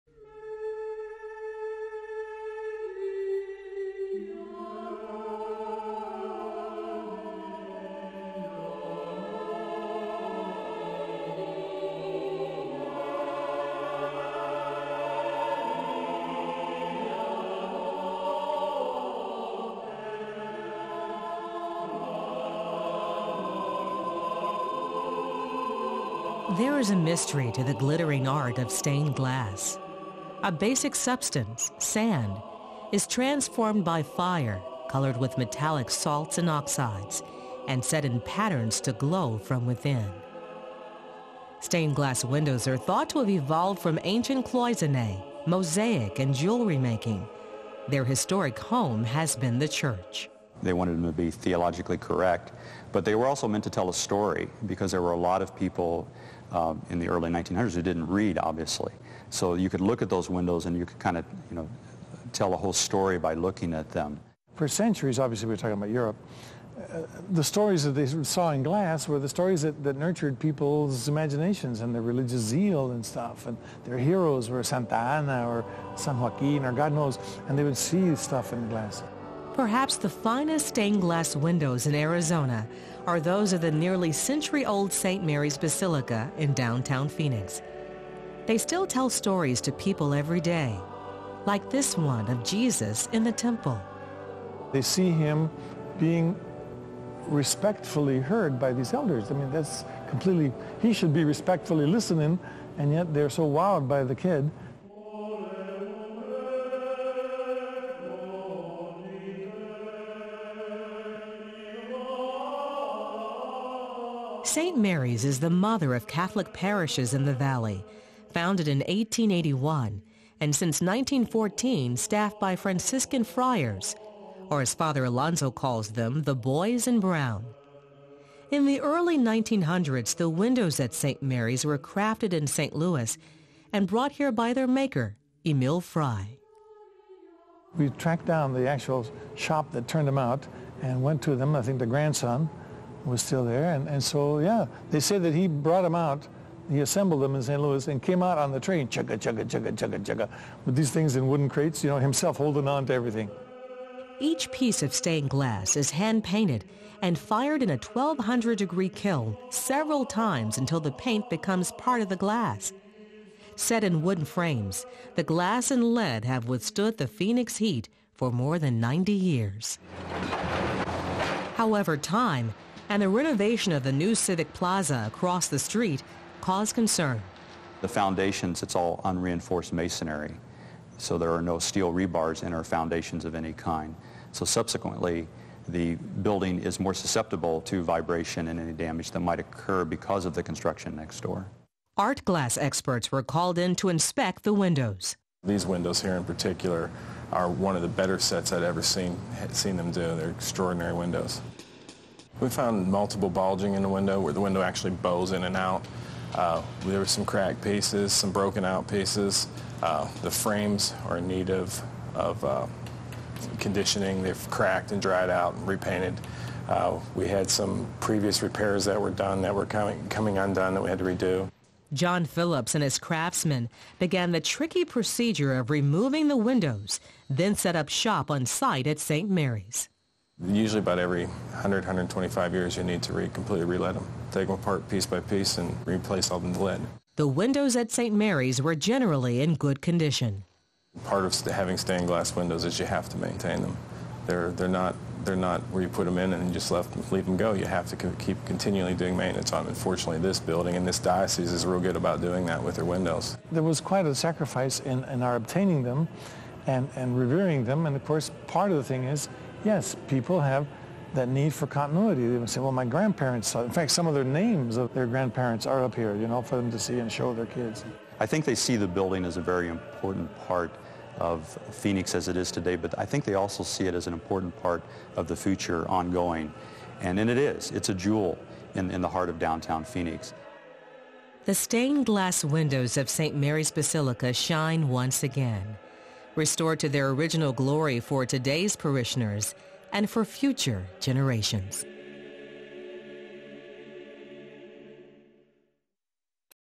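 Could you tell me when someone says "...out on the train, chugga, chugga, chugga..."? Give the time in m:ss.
2:28.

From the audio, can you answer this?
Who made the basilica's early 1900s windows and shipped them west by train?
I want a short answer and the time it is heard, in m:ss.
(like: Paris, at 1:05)
Emil Frei, at 2:15.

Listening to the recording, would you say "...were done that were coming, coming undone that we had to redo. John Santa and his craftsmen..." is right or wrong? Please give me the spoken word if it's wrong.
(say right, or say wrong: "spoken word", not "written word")
wrong: "Phillips", not "Santa".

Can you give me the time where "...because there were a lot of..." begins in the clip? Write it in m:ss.
0:54.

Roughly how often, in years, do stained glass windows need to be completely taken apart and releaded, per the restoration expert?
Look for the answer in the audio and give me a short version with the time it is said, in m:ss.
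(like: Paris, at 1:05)
100 to 125 years, at 3:51.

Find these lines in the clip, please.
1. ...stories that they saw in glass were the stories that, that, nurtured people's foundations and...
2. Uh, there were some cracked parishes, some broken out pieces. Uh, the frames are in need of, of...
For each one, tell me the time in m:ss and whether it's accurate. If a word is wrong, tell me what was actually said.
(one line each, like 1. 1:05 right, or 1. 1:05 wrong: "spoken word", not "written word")
1. 1:07 wrong: "imaginations", not "foundations"
2. 3:26 wrong: "pieces", not "parishes".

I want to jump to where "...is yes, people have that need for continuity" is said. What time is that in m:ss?
4:19.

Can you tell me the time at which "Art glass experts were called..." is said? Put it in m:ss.
3:11.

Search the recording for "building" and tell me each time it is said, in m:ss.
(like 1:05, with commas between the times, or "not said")
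3:05, 4:10, 4:28.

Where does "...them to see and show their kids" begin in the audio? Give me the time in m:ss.
4:26.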